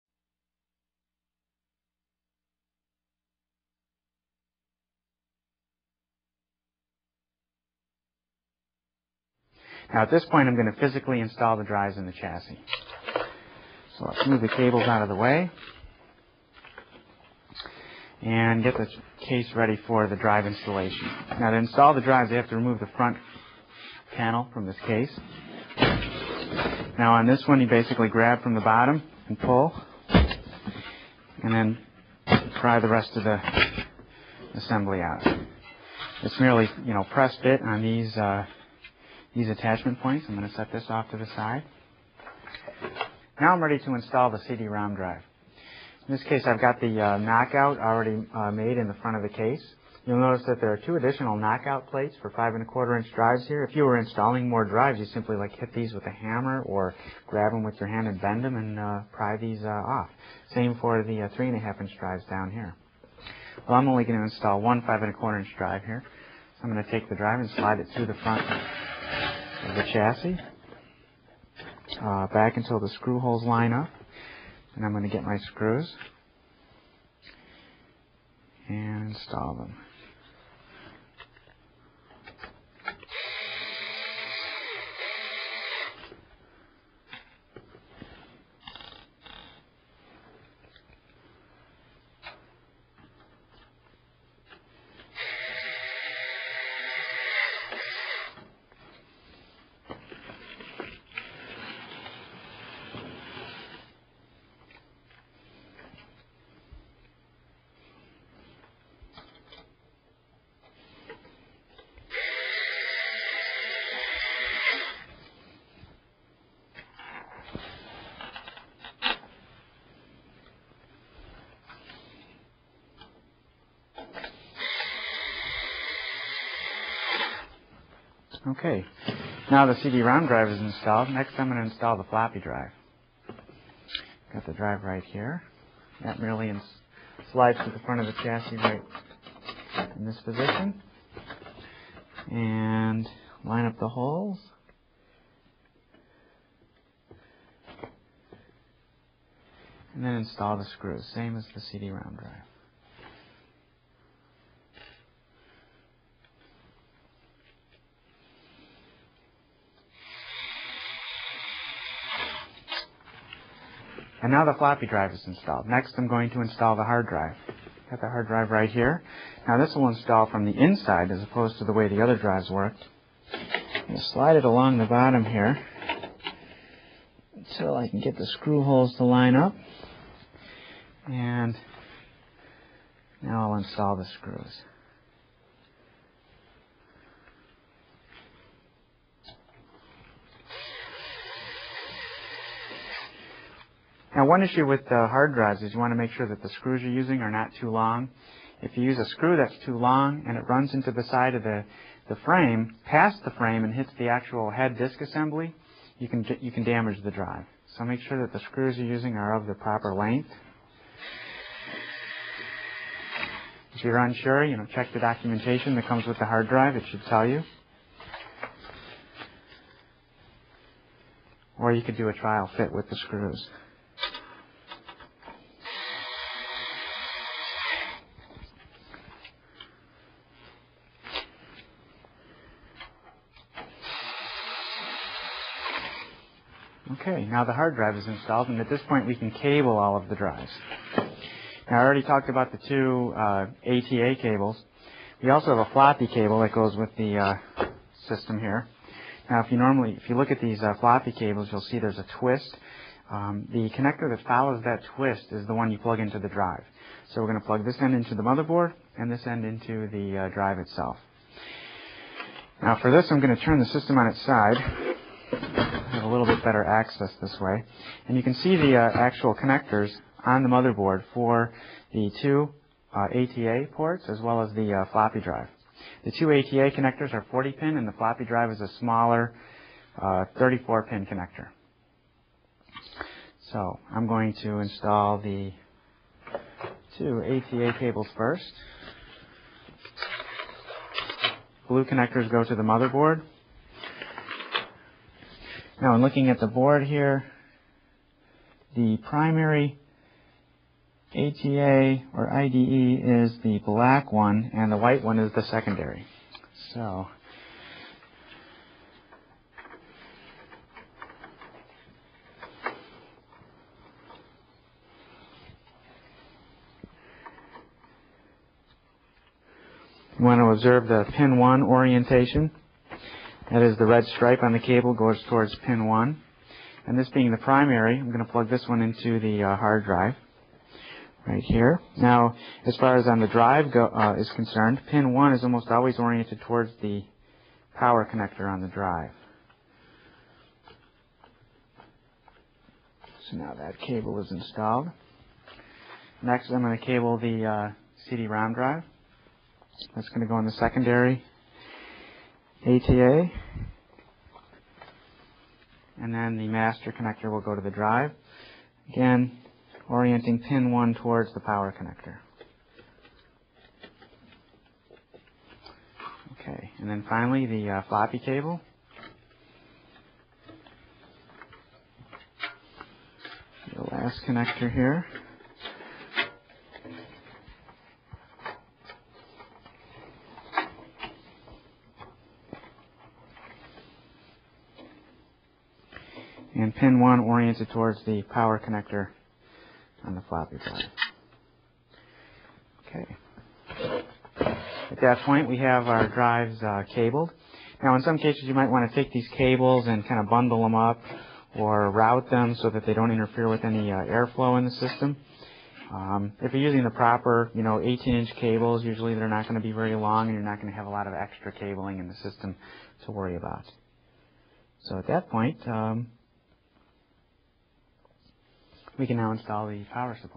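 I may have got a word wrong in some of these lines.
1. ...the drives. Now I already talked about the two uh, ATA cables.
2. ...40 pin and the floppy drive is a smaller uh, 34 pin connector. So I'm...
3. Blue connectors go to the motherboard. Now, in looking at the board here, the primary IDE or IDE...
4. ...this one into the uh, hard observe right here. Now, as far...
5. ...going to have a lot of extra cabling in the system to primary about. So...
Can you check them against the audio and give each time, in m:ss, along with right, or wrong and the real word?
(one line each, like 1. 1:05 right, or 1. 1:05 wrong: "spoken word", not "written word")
1. 4:00 right
2. 4:37 right
3. 4:51 wrong: "ATA", not "IDE"
4. 5:28 wrong: "drive", not "observe"
5. 6:50 wrong: "worry", not "primary".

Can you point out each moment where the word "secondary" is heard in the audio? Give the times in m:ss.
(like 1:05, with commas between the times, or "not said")
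5:05, 5:50.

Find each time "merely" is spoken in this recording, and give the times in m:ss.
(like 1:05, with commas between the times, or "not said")
0:36, 2:16.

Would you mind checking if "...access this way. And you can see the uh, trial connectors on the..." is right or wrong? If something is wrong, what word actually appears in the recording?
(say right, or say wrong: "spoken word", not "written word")
wrong: "actual", not "trial".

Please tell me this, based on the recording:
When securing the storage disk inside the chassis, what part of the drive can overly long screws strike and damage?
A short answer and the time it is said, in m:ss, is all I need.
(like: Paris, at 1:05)
head disk assembly, at 3:24.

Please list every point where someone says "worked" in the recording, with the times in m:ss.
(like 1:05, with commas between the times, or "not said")
2:52.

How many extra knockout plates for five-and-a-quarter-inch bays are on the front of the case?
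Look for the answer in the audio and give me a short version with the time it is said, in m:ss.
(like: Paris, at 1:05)
2, at 0:50.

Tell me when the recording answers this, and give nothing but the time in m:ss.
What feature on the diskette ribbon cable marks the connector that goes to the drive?
4:11.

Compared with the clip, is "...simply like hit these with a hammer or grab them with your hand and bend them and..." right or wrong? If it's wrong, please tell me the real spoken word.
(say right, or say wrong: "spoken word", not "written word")
right.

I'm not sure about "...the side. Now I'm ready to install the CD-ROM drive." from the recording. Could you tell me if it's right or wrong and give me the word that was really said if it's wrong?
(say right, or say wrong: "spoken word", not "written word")
right.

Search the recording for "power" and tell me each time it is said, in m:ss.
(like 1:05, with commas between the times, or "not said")
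5:37, 6:01, 6:28, 6:59.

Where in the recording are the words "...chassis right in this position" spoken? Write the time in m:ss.
2:18.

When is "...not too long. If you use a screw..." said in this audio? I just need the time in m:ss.
3:17.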